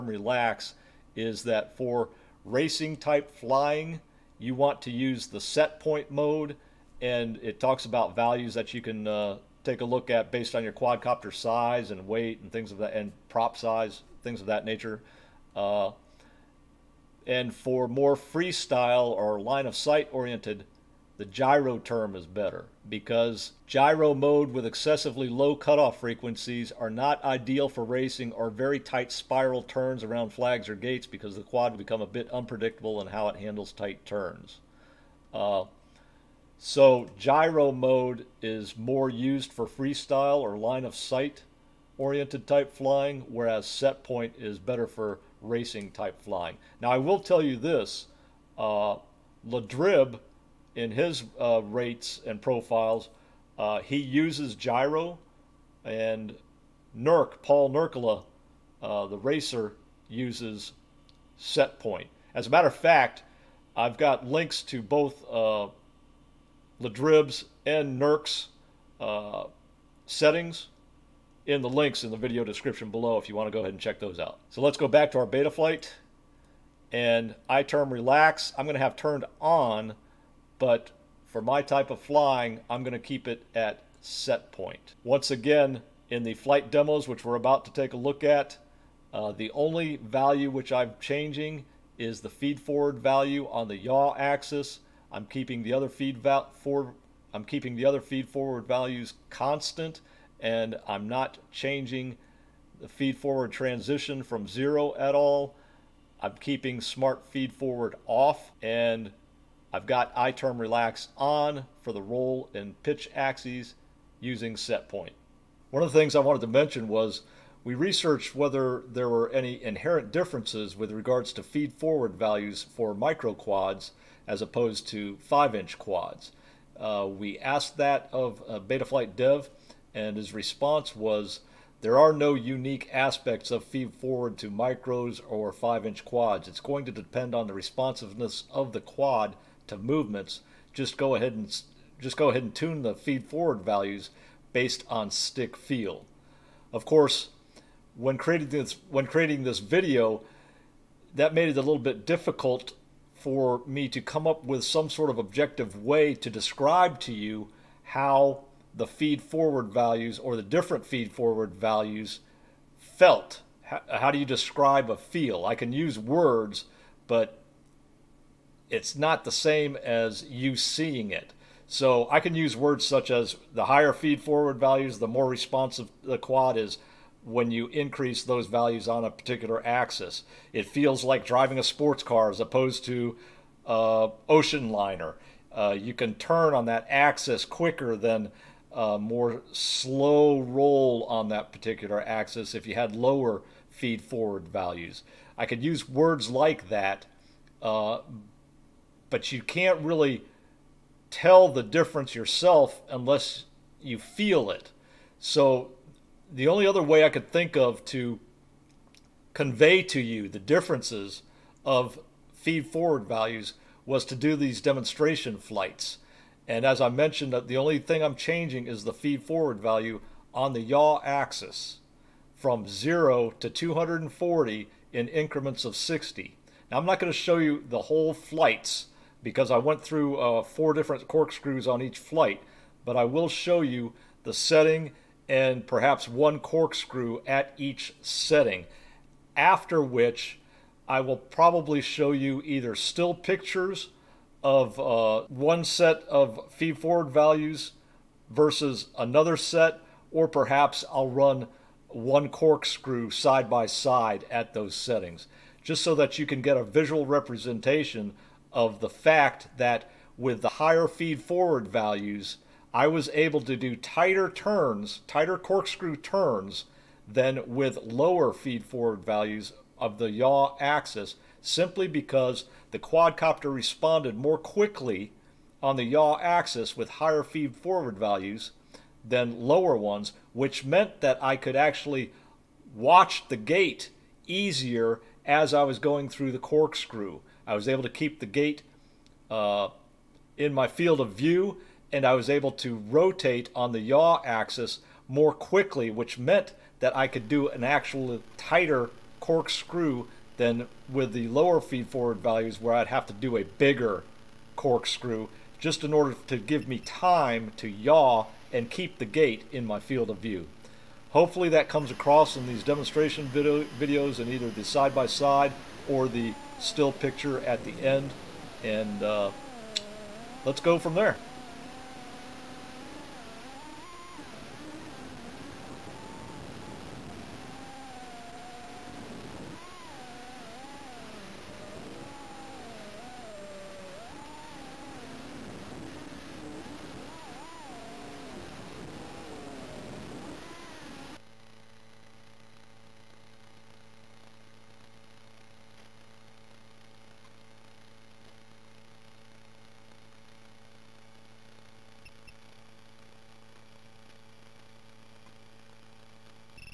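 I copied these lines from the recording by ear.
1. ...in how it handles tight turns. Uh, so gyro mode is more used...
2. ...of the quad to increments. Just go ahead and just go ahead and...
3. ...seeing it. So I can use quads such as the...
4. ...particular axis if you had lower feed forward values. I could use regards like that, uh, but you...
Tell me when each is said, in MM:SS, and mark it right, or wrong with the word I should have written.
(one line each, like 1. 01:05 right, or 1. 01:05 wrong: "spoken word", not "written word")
1. 00:33 right
2. 02:18 wrong: "movements", not "increments"
3. 02:50 wrong: "words", not "quads"
4. 03:11 wrong: "words", not "regards".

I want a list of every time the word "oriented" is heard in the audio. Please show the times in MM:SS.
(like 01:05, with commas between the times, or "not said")
00:20, 00:41.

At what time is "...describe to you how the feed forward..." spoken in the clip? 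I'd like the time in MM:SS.
02:36.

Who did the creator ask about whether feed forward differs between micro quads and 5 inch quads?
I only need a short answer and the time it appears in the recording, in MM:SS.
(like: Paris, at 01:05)
Betaflight Dev, at 02:08.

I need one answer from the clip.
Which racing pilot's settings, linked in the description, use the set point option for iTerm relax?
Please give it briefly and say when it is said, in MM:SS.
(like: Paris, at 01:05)
Paul Nurkkala, at 00:57.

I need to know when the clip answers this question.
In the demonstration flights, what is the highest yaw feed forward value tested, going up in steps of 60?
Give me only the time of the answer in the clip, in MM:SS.
03:43.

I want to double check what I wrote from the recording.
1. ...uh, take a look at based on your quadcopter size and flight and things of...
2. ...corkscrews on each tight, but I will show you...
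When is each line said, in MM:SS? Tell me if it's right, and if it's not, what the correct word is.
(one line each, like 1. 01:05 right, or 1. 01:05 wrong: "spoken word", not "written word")
1. 00:09 wrong: "weight", not "flight"
2. 03:51 wrong: "flight", not "tight".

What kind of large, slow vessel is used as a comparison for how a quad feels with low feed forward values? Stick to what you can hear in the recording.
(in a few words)
ocean liner.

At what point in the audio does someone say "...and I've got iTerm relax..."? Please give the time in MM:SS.
01:48.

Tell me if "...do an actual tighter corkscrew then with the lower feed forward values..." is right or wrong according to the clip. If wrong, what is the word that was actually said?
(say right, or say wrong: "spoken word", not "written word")
right.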